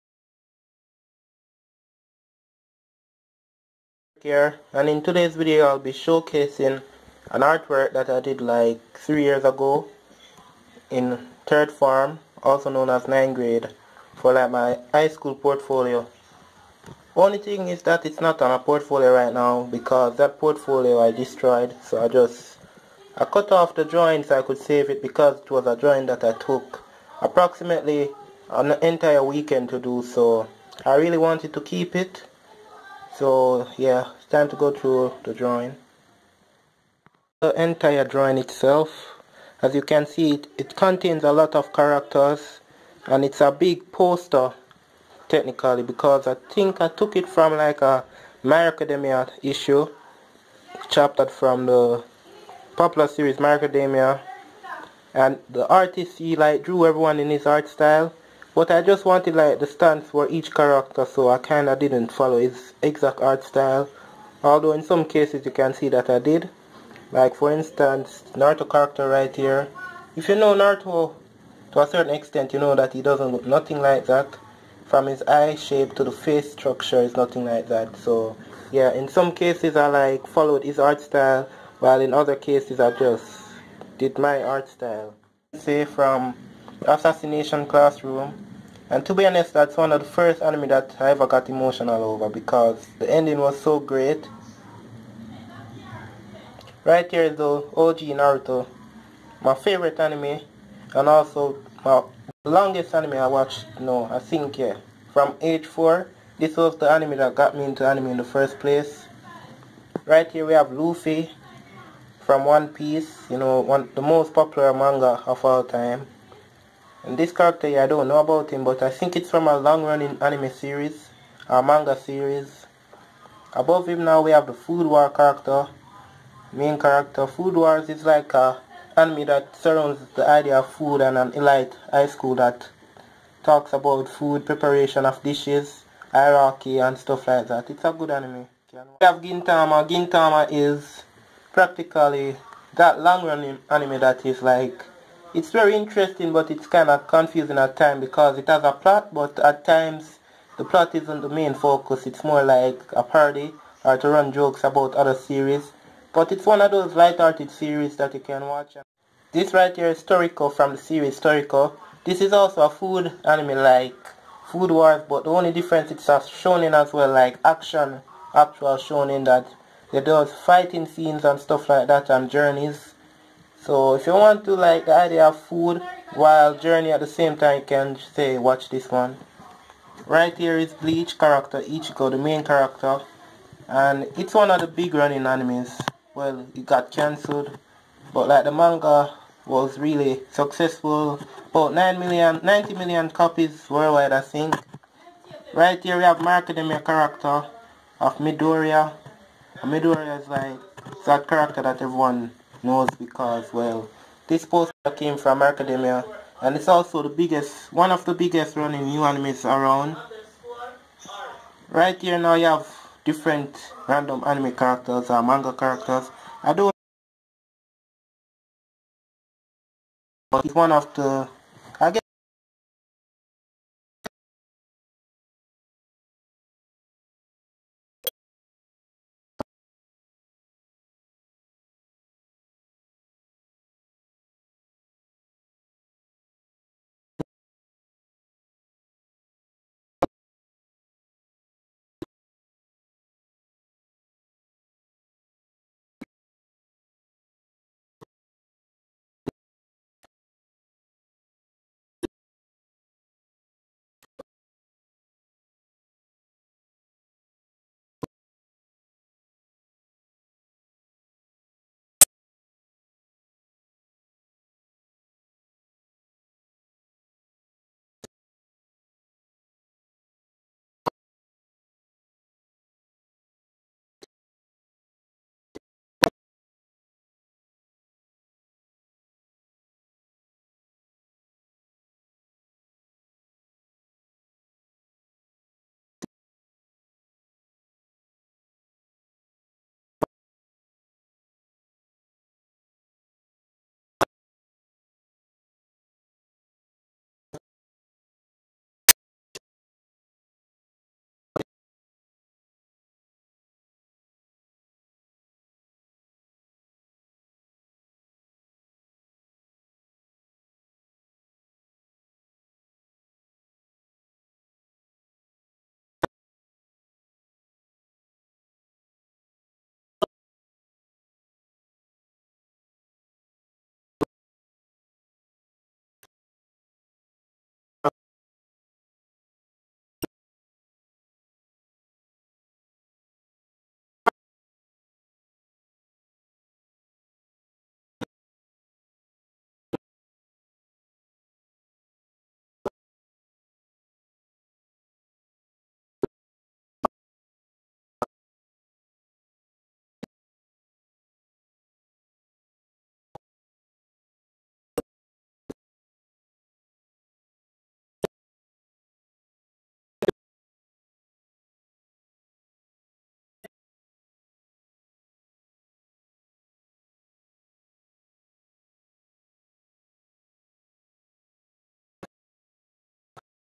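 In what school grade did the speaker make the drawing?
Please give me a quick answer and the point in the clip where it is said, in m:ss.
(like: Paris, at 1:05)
Ninth grade, at 0:13.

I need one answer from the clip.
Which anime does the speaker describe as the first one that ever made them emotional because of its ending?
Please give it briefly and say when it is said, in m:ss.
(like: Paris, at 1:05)
Assassination Classroom, at 1:26.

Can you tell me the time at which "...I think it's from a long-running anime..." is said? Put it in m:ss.
1:58.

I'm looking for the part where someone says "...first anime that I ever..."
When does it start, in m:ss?
1:30.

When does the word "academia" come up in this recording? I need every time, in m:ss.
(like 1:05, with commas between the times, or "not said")
0:48, 0:53, 3:25.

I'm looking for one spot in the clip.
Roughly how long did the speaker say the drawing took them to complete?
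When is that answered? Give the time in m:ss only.
0:28.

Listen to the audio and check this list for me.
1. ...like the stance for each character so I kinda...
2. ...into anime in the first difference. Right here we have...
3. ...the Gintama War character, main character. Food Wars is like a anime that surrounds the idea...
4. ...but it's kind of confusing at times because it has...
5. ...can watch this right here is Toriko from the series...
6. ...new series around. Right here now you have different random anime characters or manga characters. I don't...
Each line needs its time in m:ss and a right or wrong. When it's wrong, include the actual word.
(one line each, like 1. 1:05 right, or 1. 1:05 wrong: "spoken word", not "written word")
1. 0:59 right
2. 1:47 wrong: "place", not "difference"
3. 2:04 wrong: "Food", not "Gintama"
4. 2:26 right
5. 2:38 right
6. 3:28 wrong: "animes", not "series".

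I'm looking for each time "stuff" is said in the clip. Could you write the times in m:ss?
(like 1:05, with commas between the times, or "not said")
2:16, 2:51.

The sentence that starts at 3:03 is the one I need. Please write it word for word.
And it's one of the big running animes.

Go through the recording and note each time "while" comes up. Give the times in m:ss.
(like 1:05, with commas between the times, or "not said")
1:21, 2:56.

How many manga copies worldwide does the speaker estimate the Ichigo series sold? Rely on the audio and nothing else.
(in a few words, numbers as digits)
90 million.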